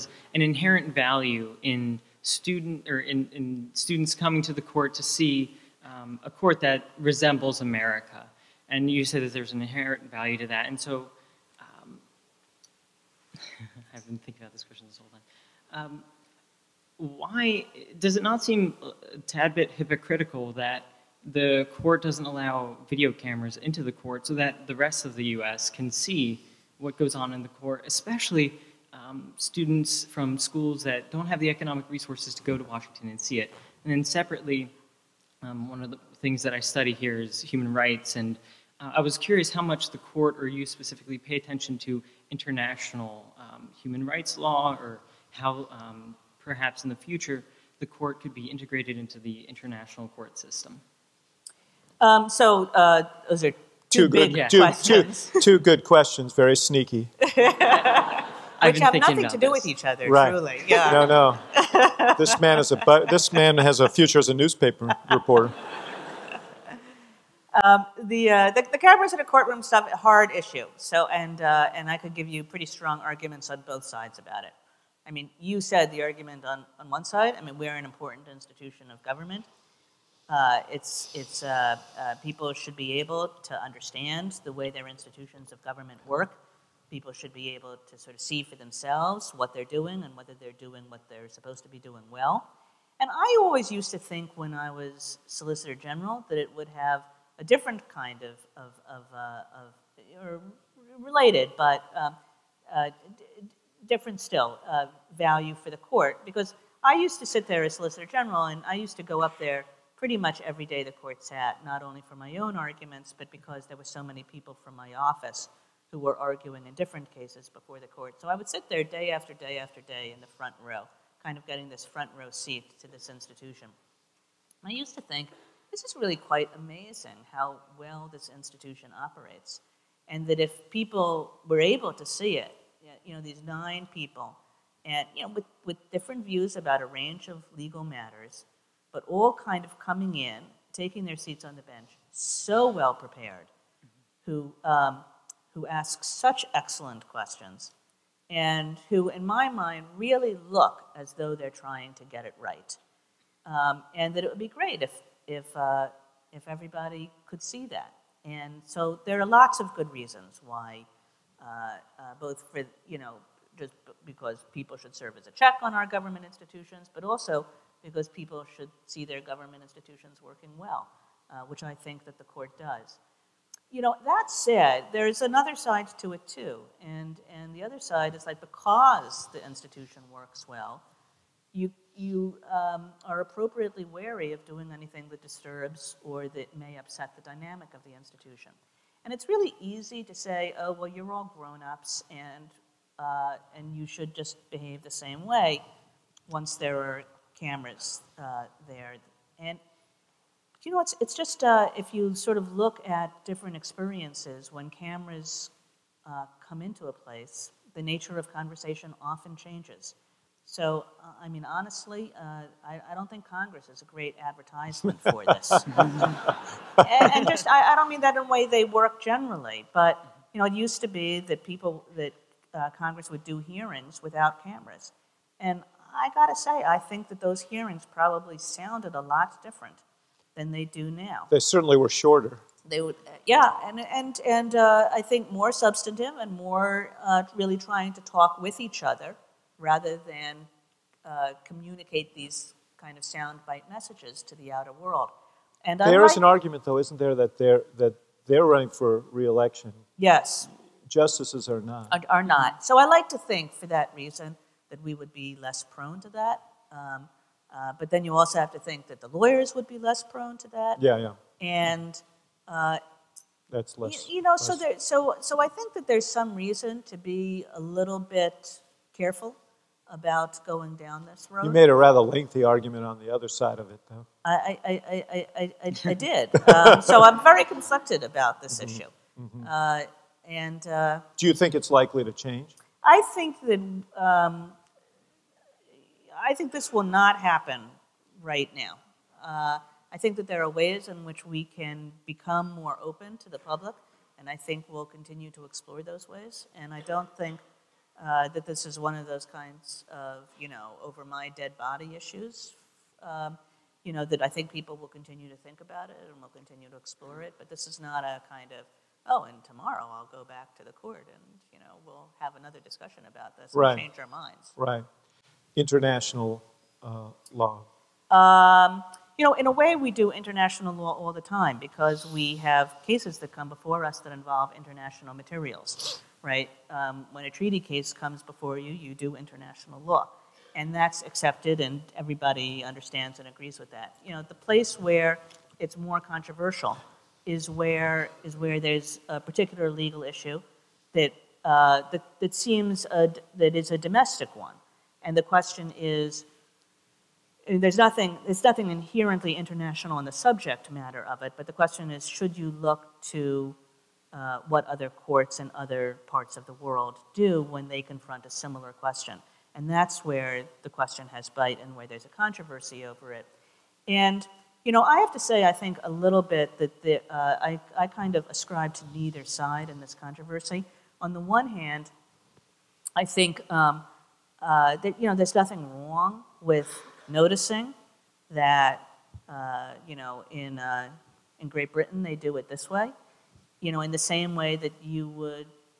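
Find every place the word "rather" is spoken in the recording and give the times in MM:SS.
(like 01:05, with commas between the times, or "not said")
03:59, 04:31.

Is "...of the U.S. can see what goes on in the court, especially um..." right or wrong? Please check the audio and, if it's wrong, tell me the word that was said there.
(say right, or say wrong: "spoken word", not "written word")
right.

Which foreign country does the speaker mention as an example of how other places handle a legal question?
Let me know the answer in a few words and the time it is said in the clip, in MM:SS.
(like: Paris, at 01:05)
Great Britain, at 06:21.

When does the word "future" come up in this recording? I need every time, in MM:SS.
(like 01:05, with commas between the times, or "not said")
00:46, 01:03.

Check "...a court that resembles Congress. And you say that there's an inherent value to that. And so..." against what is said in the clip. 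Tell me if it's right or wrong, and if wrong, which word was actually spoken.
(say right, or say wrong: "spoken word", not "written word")
wrong: "America", not "Congress".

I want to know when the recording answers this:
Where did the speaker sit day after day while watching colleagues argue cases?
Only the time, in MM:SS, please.
02:00.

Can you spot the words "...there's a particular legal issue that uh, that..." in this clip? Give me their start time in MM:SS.
05:38.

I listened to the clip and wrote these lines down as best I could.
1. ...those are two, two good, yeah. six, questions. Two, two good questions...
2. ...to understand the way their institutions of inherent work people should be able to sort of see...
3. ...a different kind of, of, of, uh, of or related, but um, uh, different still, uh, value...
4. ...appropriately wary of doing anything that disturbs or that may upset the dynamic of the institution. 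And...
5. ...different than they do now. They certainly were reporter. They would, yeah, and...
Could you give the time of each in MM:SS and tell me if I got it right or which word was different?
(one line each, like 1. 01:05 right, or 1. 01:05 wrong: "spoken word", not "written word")
1. 00:53 wrong: "two", not "six"
2. 01:23 wrong: "government", not "inherent"
3. 01:37 right
4. 03:03 right
5. 03:49 wrong: "shorter", not "reporter".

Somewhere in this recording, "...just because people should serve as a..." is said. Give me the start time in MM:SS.
02:43.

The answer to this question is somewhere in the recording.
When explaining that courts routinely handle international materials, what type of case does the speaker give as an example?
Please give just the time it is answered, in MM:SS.
05:27.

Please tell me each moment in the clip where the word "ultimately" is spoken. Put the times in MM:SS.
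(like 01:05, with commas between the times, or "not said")
not said.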